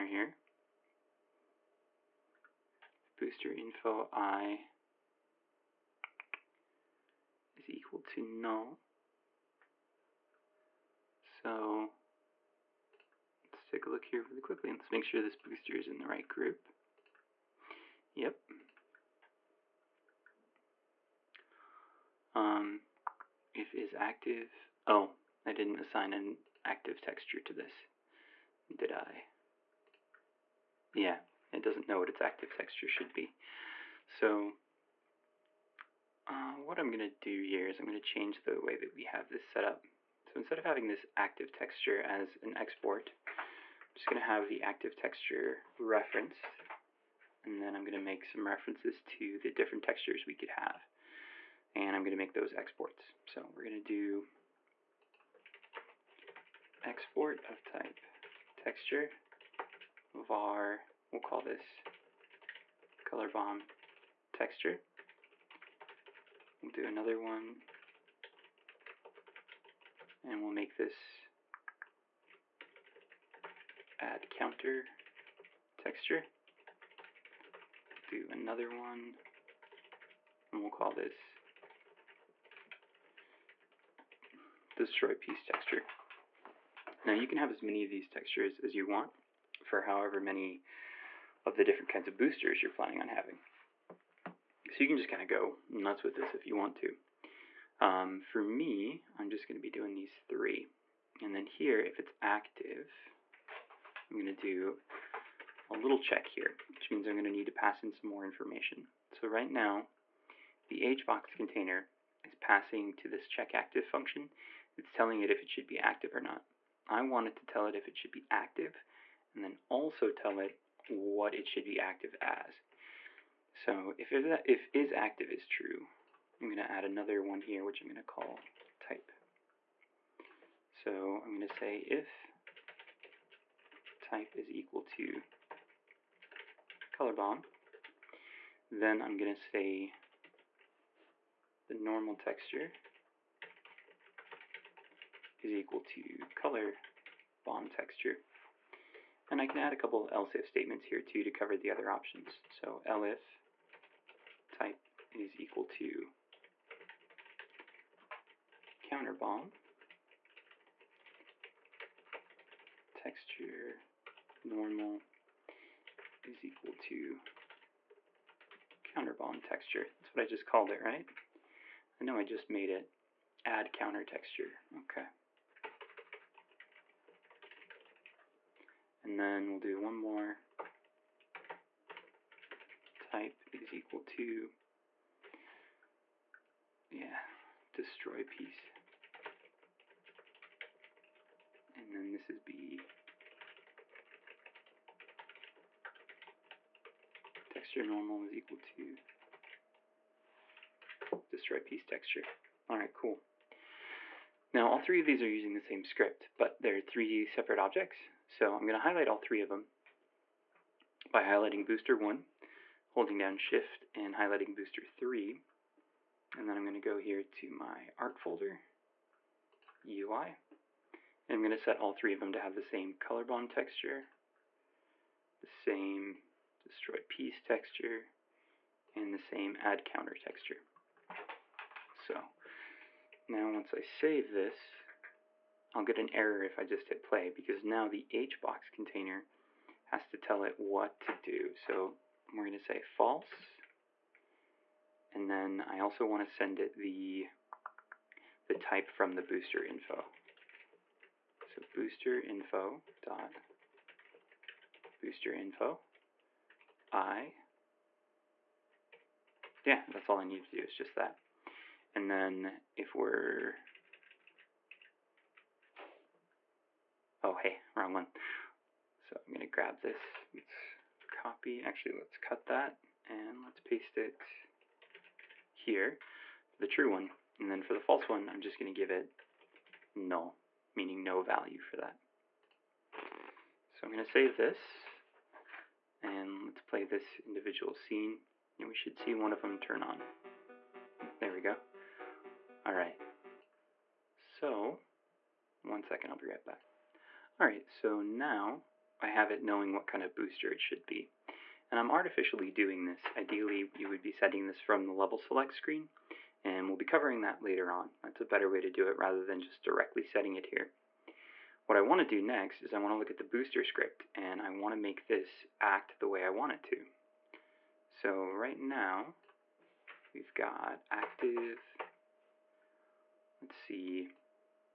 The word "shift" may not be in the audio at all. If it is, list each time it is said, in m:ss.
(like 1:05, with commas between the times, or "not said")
3:33.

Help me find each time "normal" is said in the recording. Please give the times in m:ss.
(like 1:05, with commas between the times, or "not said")
2:21, 2:44, 3:17.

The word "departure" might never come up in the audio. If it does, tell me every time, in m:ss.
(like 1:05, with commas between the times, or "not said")
not said.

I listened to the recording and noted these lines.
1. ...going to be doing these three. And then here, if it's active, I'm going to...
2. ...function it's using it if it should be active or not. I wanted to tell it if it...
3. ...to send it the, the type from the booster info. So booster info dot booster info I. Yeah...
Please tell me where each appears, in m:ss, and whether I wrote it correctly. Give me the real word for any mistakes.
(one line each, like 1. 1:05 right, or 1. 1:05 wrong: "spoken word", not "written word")
1. 1:39 right
2. 1:53 wrong: "telling", not "using"
3. 4:06 right.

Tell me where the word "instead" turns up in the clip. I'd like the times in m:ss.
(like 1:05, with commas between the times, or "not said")
0:40.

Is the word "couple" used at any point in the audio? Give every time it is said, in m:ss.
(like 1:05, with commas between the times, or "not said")
2:29.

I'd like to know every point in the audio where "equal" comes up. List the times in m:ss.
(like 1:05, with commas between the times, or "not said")
0:07, 2:14, 2:25, 2:35, 2:46, 3:03, 3:18.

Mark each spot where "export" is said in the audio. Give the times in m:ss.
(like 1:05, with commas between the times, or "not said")
0:42, 0:52, 0:56.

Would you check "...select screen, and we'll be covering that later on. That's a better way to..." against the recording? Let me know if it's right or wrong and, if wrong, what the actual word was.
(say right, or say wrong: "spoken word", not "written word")
right.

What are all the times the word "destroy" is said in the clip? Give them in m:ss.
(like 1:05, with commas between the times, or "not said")
1:24, 3:07, 3:21, 3:46.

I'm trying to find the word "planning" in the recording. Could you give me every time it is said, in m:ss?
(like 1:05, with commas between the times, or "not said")
1:32.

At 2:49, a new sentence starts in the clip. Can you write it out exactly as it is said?
That's what I just called it, right?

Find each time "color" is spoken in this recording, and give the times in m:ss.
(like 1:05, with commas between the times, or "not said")
1:03, 2:16, 2:26, 3:42.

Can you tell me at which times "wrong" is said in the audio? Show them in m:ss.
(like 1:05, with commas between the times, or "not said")
4:27.